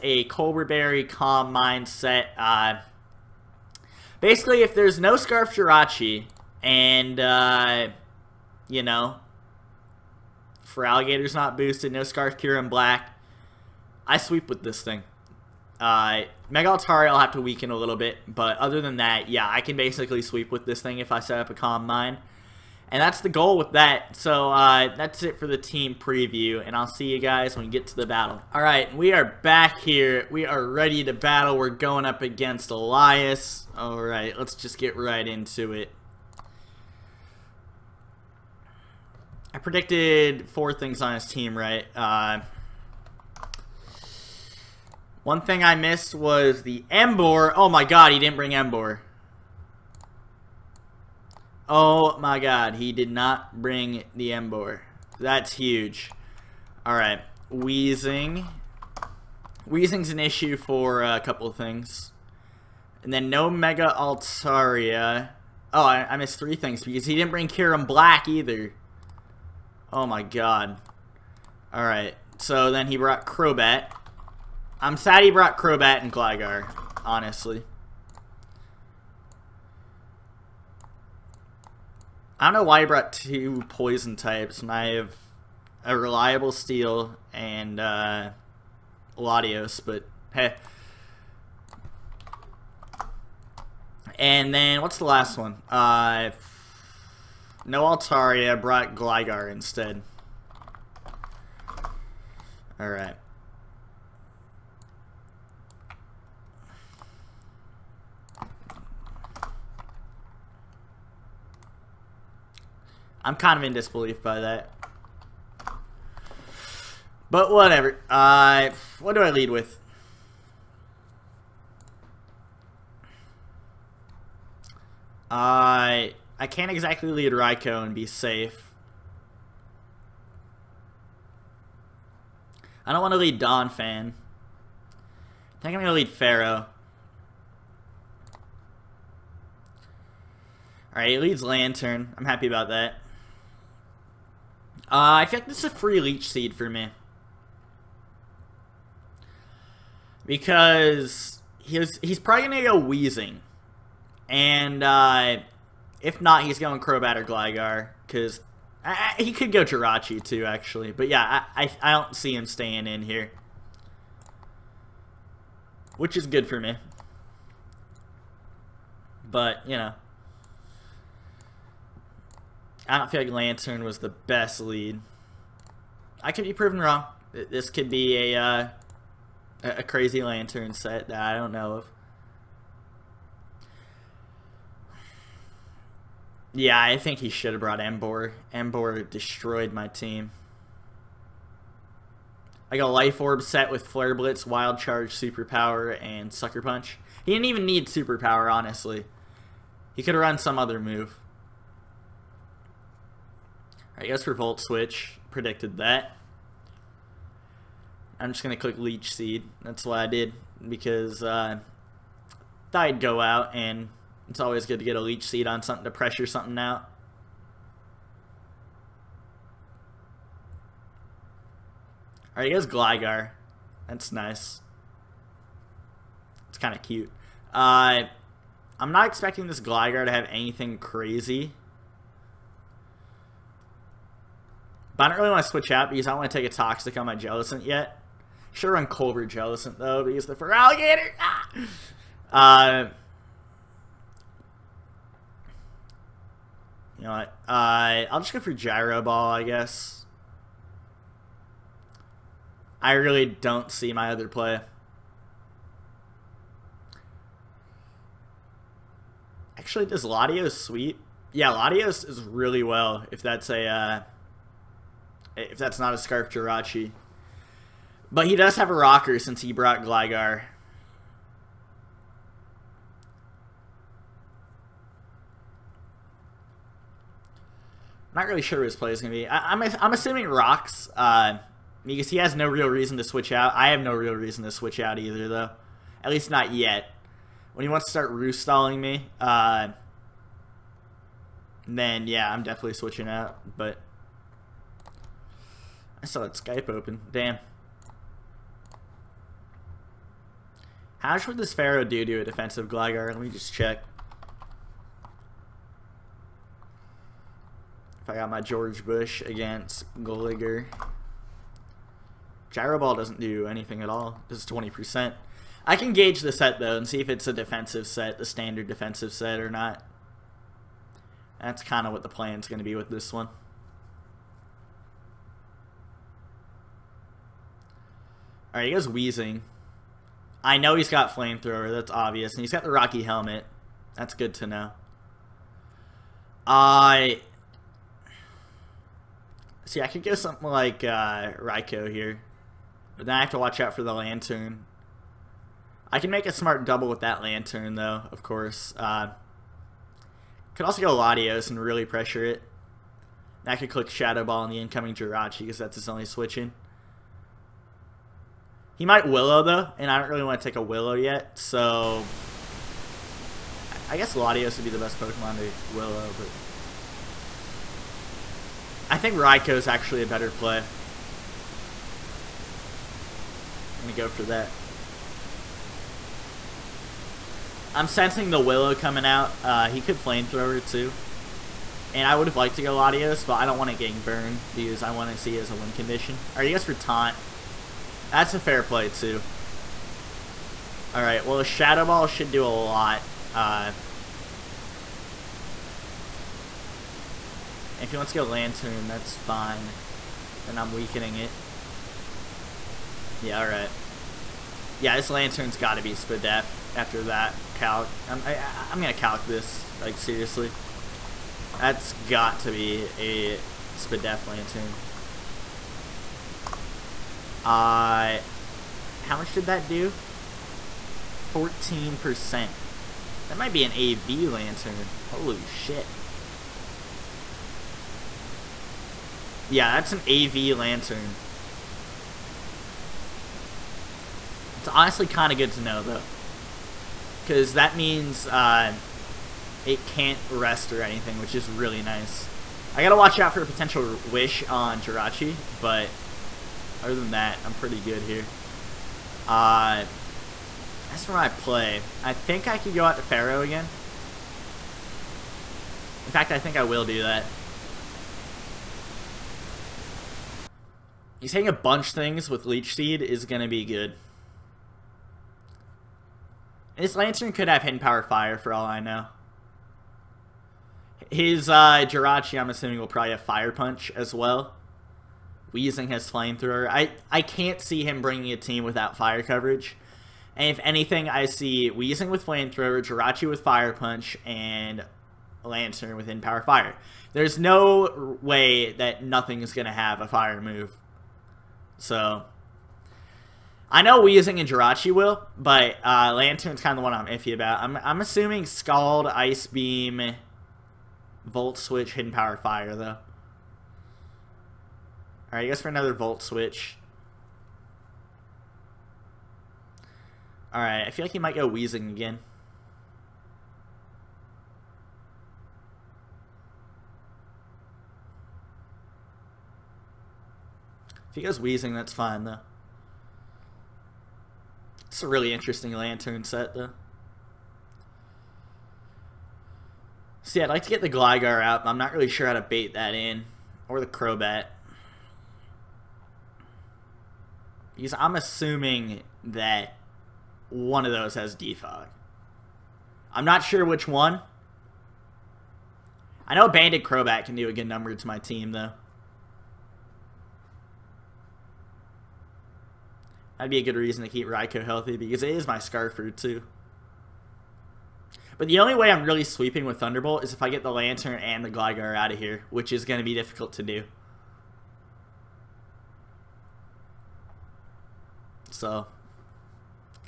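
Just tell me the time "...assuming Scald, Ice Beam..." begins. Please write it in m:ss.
8:18.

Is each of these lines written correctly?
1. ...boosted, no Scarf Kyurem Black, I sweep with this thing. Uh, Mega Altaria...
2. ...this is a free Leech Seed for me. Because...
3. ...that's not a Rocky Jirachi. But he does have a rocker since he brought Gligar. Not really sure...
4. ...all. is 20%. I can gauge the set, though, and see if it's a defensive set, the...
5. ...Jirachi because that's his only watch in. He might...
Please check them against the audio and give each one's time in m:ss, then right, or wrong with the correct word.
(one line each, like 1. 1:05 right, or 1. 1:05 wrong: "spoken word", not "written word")
1. 0:11 right
2. 2:25 right
3. 4:25 wrong: "Scarf", not "Rocky"
4. 5:13 right
5. 5:54 wrong: "switch", not "watch".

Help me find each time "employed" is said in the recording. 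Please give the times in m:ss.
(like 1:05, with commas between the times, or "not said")
not said.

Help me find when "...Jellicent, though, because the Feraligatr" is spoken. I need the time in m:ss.
3:59.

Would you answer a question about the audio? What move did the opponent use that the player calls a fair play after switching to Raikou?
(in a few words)
Taunt.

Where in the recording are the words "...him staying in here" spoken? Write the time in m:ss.
2:42.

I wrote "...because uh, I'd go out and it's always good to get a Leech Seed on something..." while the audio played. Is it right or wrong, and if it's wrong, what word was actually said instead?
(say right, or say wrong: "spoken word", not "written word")
right.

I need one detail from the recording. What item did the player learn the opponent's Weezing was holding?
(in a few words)
Rocky Helmet.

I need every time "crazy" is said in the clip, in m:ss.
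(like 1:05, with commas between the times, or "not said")
2:59, 3:50.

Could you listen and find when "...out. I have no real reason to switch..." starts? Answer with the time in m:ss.
4:43.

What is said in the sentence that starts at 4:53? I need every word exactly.
But I saw that Skype open.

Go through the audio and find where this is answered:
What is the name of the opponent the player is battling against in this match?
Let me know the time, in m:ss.
0:32.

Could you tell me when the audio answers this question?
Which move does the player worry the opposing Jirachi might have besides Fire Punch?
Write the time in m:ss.
7:24.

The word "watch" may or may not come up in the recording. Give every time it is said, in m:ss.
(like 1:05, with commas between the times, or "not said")
5:43, 7:22.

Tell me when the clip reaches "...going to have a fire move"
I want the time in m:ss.
8:09.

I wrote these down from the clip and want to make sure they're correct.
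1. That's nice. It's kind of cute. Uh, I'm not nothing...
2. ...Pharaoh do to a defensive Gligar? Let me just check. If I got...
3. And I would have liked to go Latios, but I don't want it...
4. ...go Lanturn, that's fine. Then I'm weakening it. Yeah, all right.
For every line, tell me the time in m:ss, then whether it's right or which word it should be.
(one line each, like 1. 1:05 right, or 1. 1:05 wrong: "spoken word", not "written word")
1. 3:43 wrong: "expecting", not "nothing"
2. 5:01 right
3. 6:21 right
4. 6:38 right.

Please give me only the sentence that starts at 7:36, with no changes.
In fact, I think I will do that.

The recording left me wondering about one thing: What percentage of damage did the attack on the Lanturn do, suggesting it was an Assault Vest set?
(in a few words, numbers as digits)
14%.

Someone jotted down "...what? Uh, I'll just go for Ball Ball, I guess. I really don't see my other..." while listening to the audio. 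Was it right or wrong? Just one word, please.
wrong.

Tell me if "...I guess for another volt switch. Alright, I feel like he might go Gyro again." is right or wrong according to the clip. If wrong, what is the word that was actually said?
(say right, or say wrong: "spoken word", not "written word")
wrong: "Weezing", not "Gyro".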